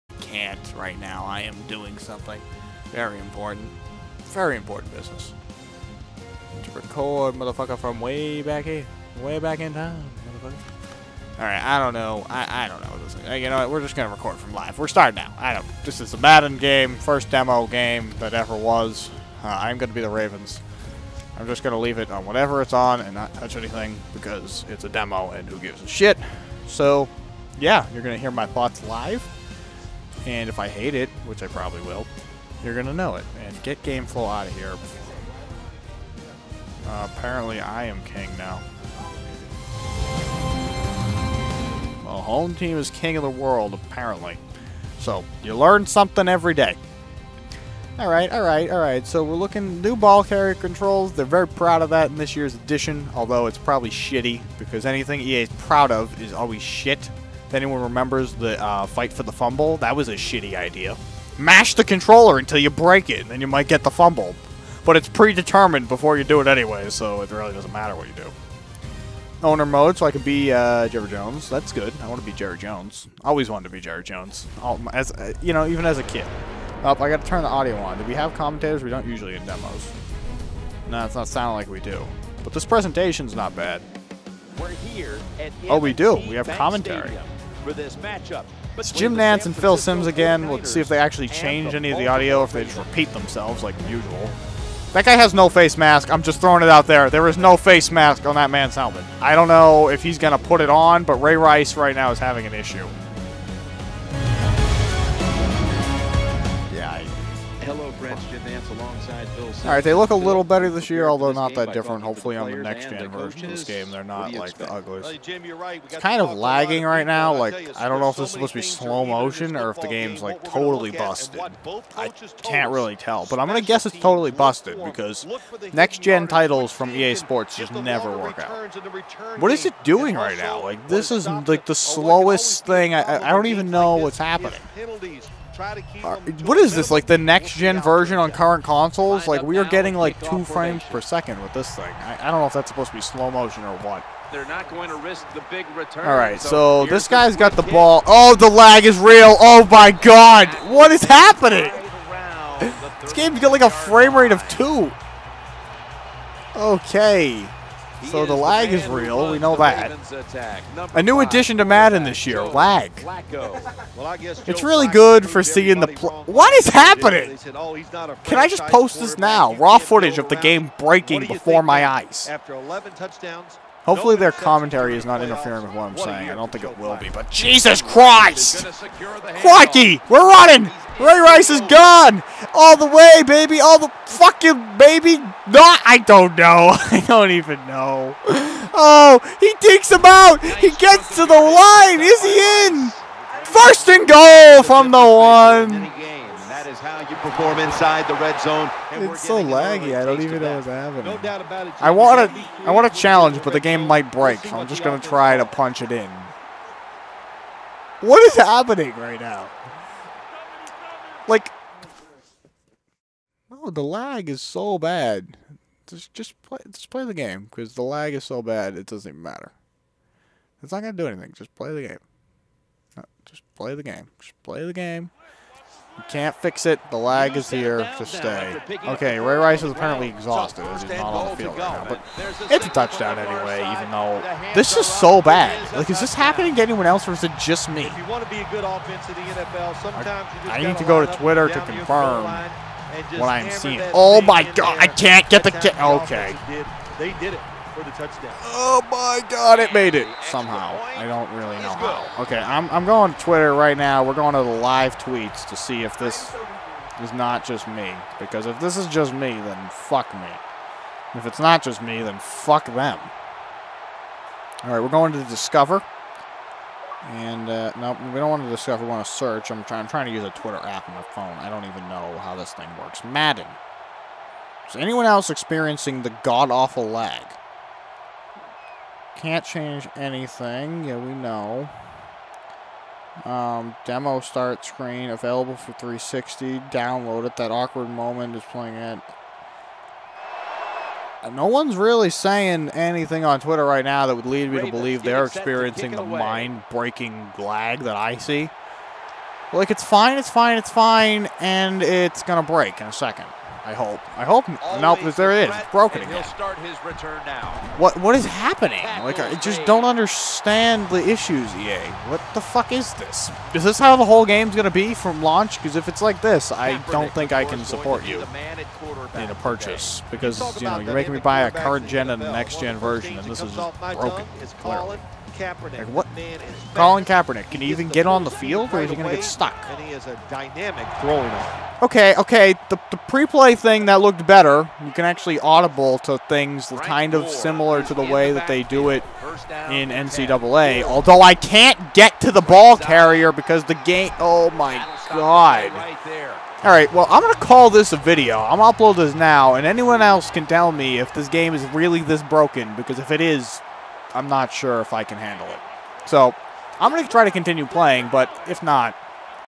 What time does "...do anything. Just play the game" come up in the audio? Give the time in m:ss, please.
3:40.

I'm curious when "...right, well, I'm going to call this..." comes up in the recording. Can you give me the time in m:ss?
5:46.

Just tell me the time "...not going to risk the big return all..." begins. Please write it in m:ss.
2:24.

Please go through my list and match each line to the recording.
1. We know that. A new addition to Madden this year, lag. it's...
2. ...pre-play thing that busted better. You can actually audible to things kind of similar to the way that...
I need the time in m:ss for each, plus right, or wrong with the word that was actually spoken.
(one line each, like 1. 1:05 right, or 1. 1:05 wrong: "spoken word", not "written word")
1. 2:39 right
2. 5:32 wrong: "looked", not "busted".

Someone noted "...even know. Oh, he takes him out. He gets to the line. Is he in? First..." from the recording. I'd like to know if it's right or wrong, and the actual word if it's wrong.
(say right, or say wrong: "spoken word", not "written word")
right.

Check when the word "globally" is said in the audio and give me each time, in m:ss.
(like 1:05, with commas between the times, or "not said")
not said.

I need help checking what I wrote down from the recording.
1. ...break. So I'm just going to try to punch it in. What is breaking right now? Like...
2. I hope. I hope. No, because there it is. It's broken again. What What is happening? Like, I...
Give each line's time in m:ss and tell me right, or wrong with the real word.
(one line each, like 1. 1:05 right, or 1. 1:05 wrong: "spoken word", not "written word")
1. 3:24 wrong: "happening", not "breaking"
2. 5:03 right.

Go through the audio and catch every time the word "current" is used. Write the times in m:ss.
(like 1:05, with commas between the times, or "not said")
2:18, 5:21.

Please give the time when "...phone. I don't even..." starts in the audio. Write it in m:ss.
4:31.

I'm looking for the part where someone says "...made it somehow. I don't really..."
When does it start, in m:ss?
4:09.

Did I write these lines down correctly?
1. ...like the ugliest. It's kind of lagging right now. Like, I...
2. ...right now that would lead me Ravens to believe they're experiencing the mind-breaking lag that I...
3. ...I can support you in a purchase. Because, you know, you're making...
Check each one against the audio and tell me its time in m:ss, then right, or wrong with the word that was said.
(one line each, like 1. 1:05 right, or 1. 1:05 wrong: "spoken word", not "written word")
1. 1:54 right
2. 4:53 right
3. 5:17 right.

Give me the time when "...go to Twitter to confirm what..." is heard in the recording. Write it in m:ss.
4:00.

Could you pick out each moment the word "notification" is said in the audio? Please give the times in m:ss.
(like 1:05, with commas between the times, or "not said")
not said.